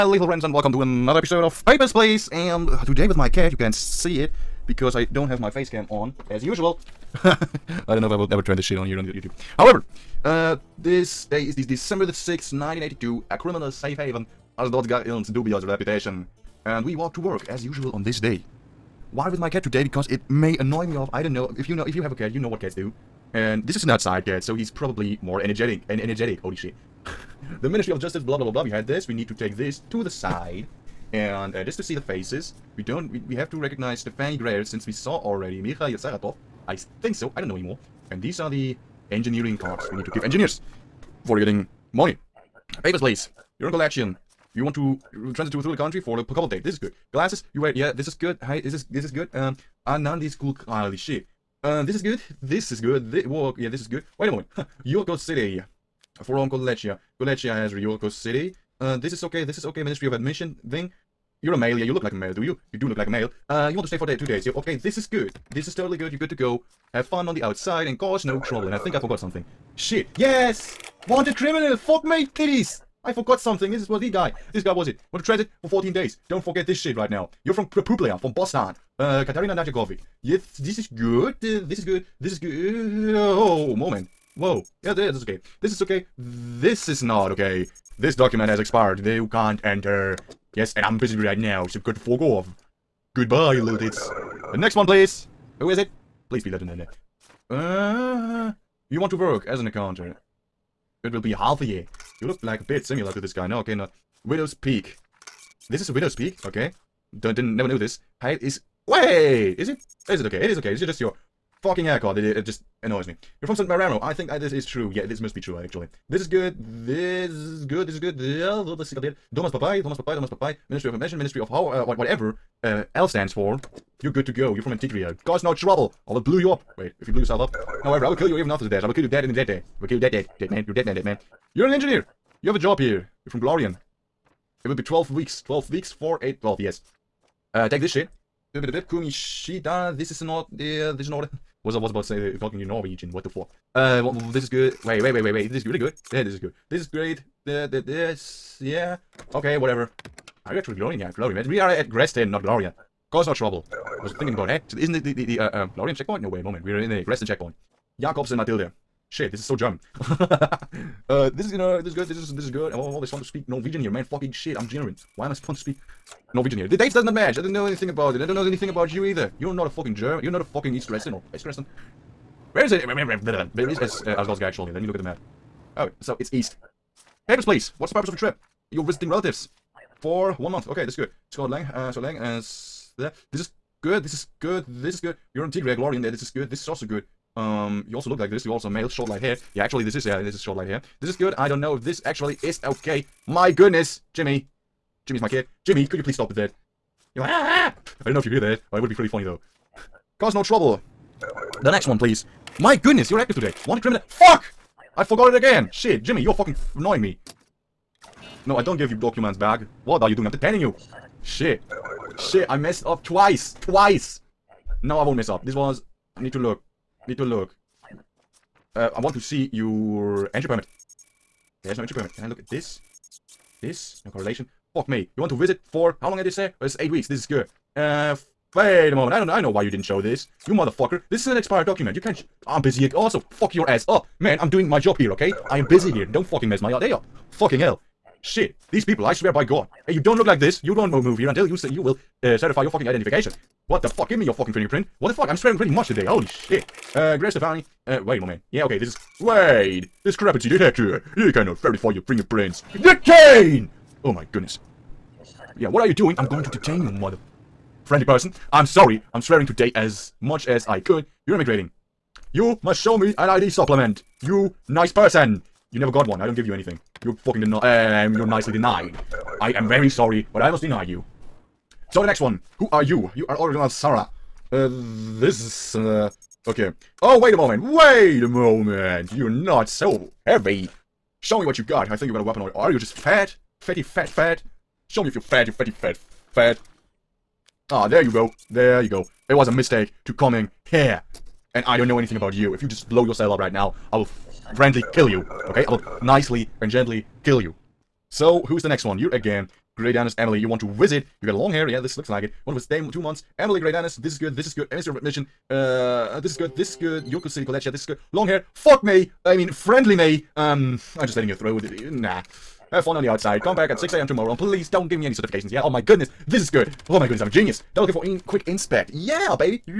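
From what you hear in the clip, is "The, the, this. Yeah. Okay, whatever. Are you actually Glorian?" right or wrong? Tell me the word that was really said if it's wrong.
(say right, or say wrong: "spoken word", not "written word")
right.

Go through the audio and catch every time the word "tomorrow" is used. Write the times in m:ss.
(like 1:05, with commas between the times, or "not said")
5:14.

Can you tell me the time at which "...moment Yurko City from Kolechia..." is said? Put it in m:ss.
0:54.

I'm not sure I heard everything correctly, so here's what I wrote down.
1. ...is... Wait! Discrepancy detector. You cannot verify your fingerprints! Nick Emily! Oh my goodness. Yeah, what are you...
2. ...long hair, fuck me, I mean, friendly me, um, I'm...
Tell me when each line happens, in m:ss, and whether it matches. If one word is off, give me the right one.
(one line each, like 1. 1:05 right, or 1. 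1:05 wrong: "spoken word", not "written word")
1. 4:08 wrong: "Kane", not "Emily"
2. 5:08 right.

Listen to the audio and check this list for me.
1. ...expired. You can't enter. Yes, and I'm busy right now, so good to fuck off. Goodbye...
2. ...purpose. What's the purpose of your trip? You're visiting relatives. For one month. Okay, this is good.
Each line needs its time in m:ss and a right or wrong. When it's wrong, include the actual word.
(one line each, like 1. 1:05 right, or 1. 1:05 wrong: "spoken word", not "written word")
1. 1:28 right
2. 2:57 wrong: "please", not "purpose".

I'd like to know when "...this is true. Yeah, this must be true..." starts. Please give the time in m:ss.
1:54.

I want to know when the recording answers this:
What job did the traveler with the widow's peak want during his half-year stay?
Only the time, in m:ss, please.
1:39.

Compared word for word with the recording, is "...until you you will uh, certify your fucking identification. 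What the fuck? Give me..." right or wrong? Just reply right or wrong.
right.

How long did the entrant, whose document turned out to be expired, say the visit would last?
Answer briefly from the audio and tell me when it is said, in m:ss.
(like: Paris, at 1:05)
8 weeks, at 3:46.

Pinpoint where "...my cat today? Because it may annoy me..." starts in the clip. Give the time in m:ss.
0:19.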